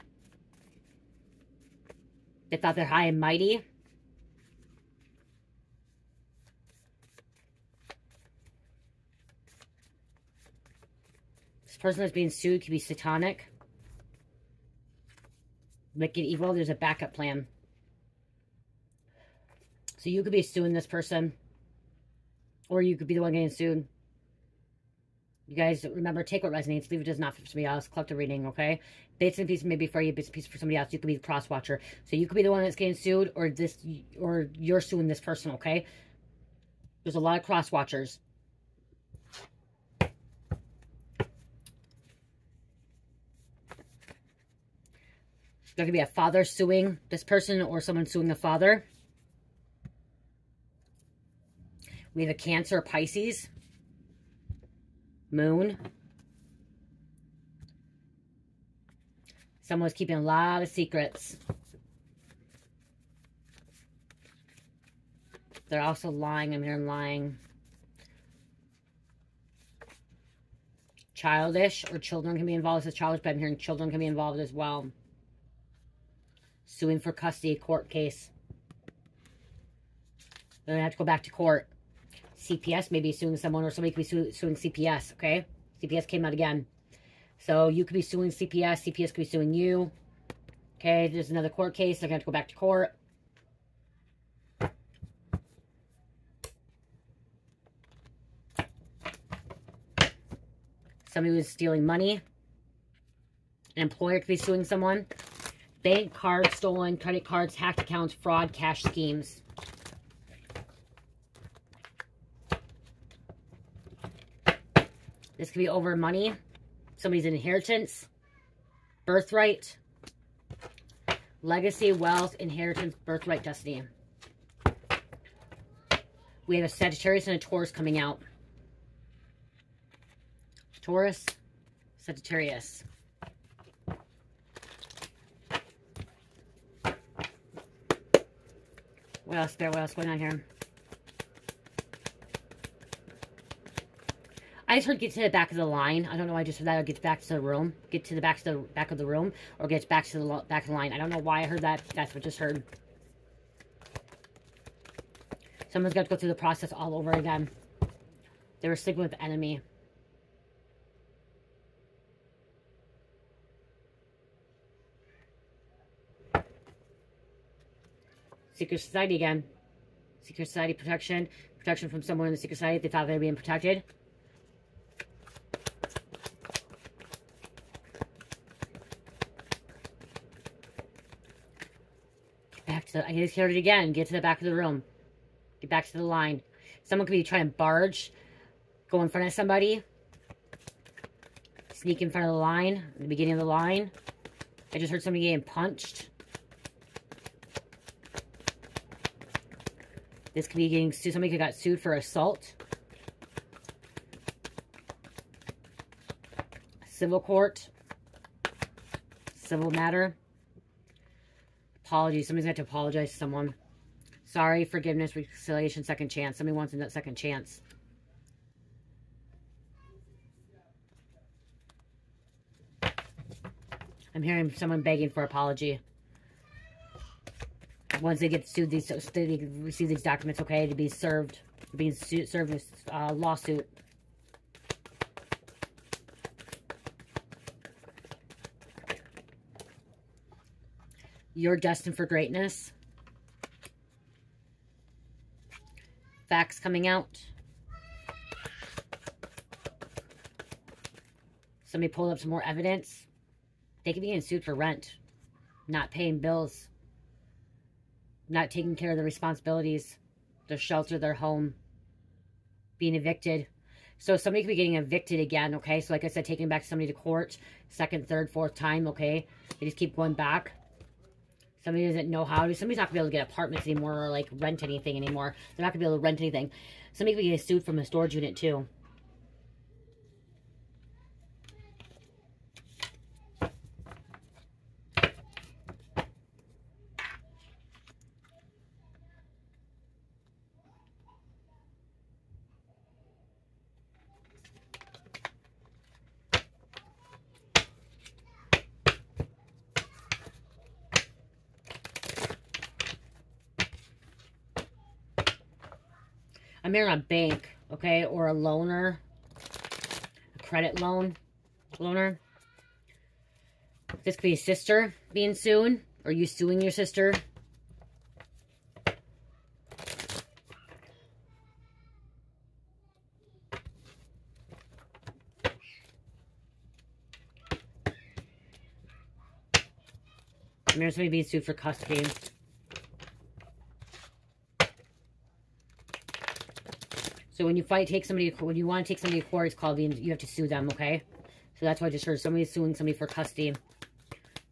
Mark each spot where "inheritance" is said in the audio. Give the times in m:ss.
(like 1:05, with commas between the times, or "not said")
1:57, 2:02.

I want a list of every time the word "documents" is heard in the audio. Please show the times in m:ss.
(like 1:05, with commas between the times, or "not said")
3:50.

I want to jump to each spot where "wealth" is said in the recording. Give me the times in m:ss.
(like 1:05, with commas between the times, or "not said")
2:01.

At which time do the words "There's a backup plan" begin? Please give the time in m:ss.
0:16.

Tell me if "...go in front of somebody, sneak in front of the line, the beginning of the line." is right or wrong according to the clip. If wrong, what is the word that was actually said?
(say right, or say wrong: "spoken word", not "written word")
right.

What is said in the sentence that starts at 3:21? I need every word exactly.
Somebody could got sued for assault.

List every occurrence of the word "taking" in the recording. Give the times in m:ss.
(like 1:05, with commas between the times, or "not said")
4:18, 4:26.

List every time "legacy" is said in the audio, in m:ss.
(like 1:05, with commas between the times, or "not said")
2:01.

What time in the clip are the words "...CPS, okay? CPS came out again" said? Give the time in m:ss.
1:24.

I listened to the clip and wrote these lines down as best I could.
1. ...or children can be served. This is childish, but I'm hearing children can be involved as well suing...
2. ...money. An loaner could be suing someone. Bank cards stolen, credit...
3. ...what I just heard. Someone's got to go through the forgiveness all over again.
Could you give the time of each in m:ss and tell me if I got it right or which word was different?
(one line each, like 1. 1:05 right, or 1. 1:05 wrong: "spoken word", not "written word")
1. 1:11 wrong: "involved", not "served"
2. 1:41 wrong: "employer", not "loaner"
3. 2:32 wrong: "process", not "forgiveness".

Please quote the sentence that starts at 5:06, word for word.
I'm in a bank, okay, or a loaner, a credit loan, loaner.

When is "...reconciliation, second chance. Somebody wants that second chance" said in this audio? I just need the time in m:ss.
3:35.